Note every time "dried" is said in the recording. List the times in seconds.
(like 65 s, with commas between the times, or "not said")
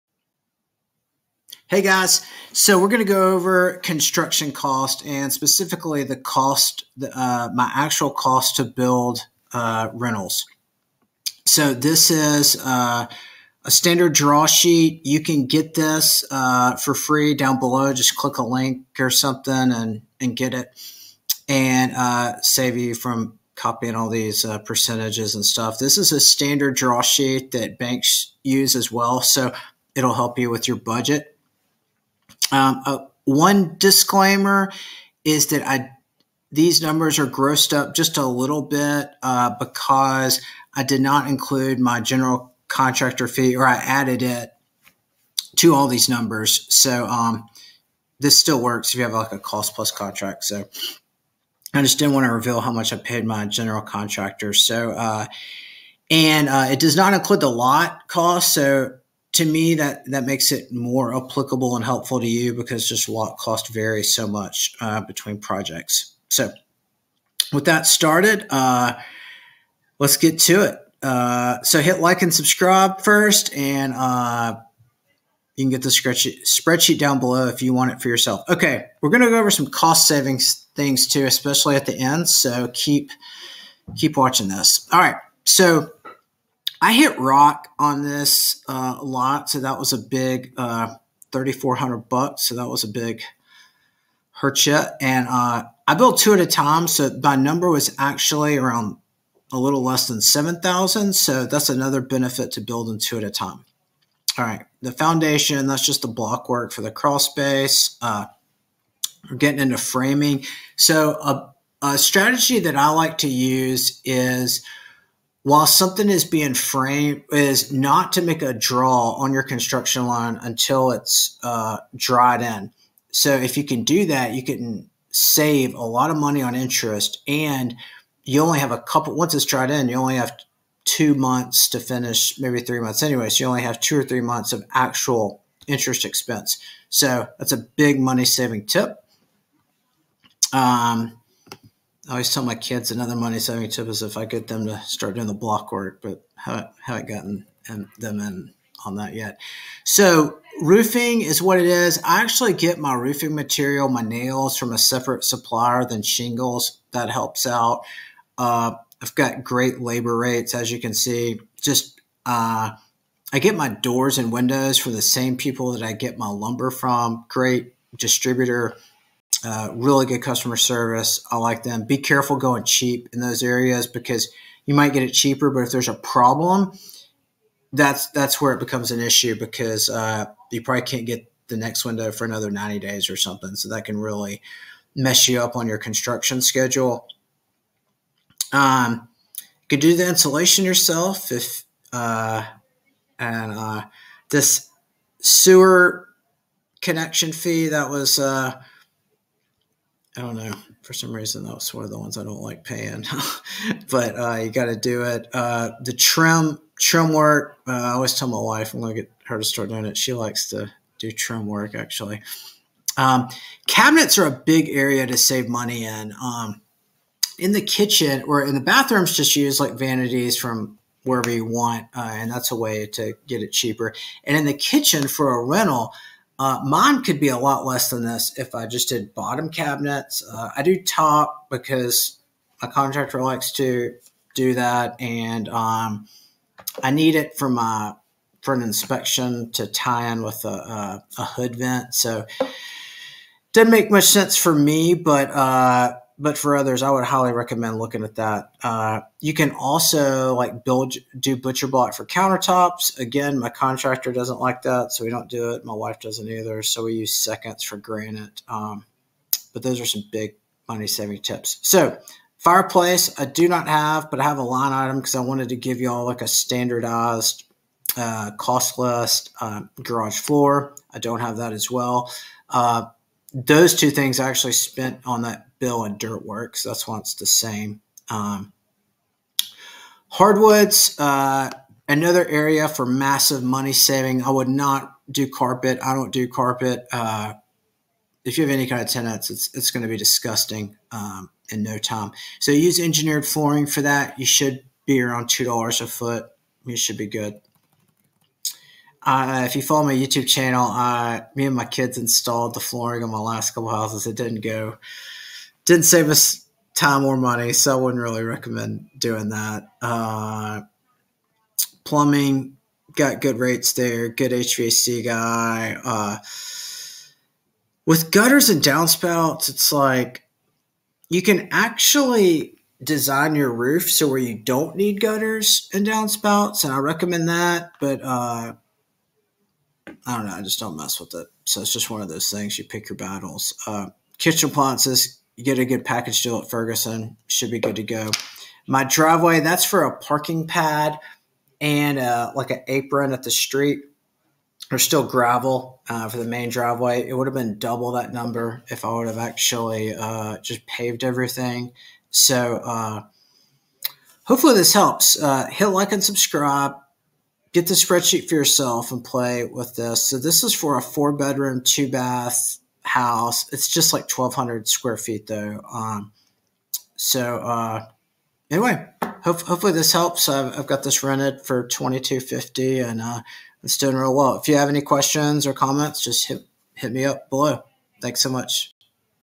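121 s, 129 s.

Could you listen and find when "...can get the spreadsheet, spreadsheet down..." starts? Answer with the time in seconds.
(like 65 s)
75 s.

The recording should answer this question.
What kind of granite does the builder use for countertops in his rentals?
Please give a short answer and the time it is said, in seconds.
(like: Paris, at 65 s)
seconds, at 257 s.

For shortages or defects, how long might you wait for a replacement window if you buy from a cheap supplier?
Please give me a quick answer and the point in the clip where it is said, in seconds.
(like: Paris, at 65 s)
90 days, at 182 s.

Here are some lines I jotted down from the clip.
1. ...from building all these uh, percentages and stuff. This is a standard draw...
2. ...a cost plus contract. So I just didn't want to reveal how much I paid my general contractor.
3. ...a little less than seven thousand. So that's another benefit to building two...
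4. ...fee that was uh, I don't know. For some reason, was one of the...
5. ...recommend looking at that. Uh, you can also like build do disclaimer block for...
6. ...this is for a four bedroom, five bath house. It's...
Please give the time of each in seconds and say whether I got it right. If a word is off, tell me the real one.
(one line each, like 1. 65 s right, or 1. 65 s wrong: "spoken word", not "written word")
1. 22 s wrong: "copying", not "building"
2. 49 s right
3. 99 s right
4. 197 s right
5. 247 s wrong: "butcher", not "disclaimer"
6. 360 s wrong: "two", not "five".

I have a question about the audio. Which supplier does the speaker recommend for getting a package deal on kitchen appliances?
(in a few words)
Ferguson.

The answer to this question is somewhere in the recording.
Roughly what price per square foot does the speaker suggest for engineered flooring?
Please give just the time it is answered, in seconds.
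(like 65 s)
295 s.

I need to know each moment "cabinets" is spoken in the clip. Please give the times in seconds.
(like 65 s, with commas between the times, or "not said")
213 s, 229 s.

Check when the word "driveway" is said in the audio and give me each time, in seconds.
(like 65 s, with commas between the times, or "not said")
338 s, 346 s.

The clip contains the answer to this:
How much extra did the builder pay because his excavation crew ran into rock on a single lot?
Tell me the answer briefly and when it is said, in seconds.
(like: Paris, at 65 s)
$3,400, at 91 s.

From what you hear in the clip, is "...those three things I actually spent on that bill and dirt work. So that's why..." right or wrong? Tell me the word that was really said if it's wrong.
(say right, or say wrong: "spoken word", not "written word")
wrong: "two", not "three".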